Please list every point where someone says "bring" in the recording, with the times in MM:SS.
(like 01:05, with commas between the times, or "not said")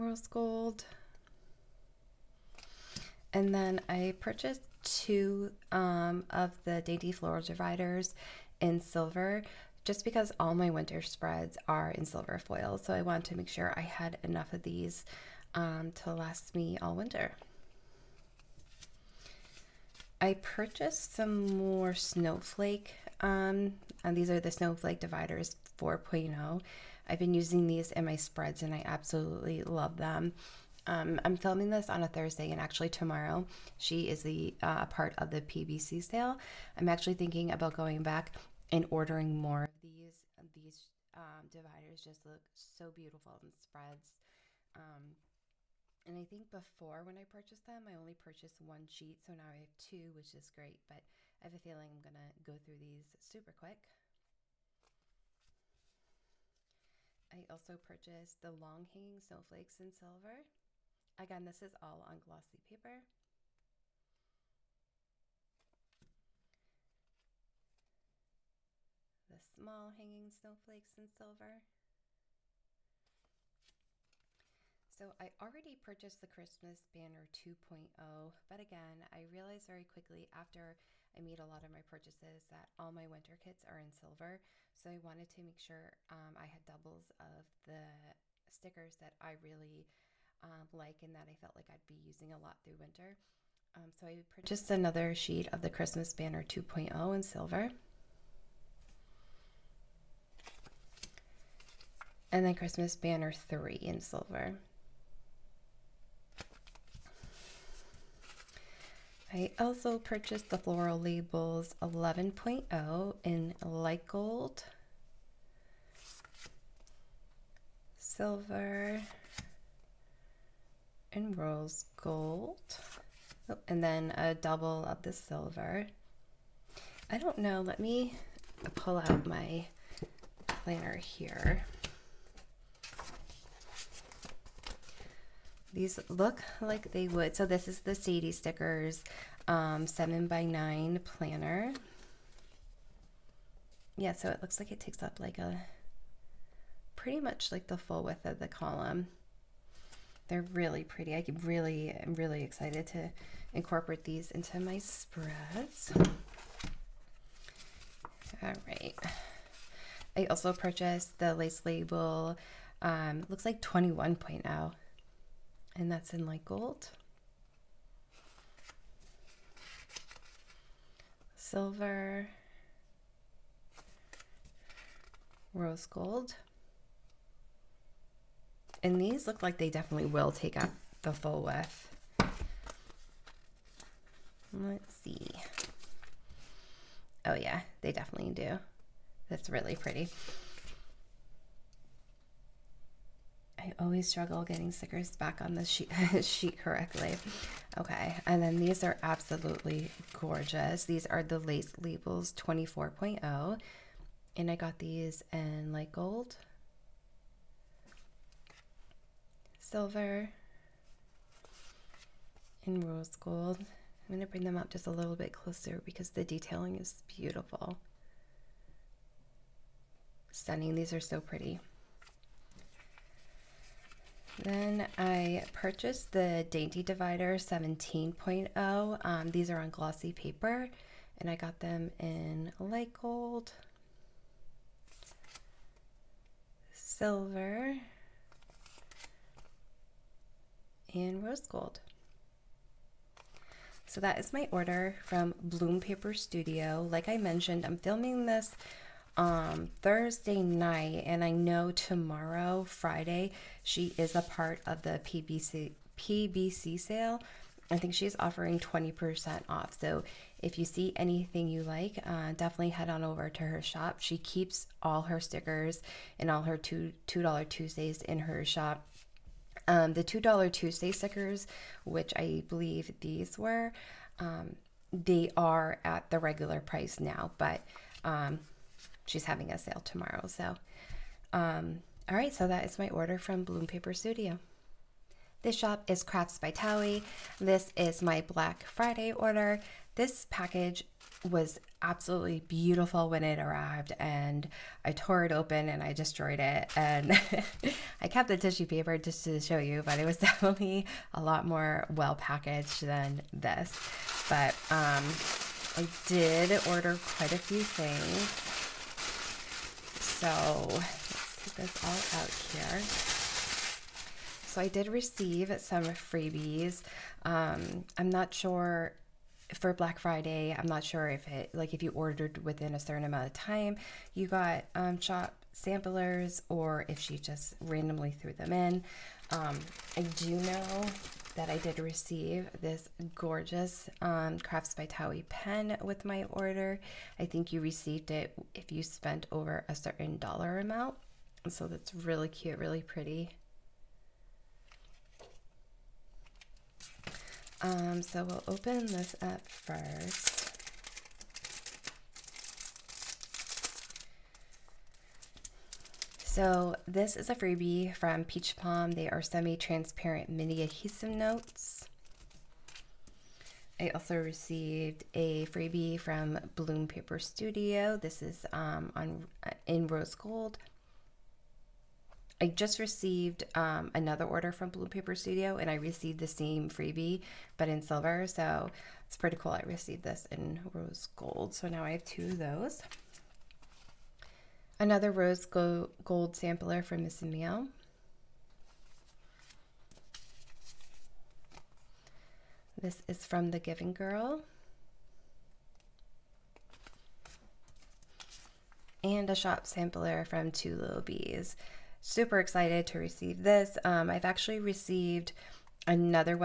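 03:34.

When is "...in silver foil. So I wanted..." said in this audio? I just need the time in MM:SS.
00:11.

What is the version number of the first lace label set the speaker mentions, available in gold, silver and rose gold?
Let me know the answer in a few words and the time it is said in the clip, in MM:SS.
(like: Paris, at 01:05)
21.0, at 02:43.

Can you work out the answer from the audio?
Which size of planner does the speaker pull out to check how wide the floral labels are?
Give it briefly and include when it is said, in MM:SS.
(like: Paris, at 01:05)
7 by 9, at 02:19.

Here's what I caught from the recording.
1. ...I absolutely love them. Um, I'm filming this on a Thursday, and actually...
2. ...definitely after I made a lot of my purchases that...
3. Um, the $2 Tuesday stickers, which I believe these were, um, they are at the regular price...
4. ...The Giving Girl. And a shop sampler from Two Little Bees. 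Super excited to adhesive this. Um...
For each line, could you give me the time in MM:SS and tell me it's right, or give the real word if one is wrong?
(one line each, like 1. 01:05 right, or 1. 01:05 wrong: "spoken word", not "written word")
1. 00:28 right
2. 01:19 wrong: "quickly", not "definitely"
3. 04:29 right
4. 06:33 wrong: "receive", not "adhesive".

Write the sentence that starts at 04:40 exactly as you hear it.
So, um, all right, so that is my order from Bloom Paper Studio.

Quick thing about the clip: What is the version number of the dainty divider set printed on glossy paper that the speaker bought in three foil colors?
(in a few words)
17.0.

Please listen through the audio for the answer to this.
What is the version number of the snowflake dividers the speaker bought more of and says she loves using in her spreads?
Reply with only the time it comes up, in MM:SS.
00:24.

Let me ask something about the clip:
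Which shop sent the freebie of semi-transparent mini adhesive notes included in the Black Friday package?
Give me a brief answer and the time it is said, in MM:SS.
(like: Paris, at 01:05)
Peach Palm, at 05:58.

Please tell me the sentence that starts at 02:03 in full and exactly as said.
Oh, and then a double of the silver.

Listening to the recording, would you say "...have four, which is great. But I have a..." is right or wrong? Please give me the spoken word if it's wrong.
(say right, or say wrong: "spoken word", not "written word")
wrong: "two", not "four".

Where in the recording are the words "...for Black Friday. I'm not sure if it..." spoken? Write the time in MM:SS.
05:19.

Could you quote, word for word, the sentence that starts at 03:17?
Okay, and then these are absolutely gorgeous.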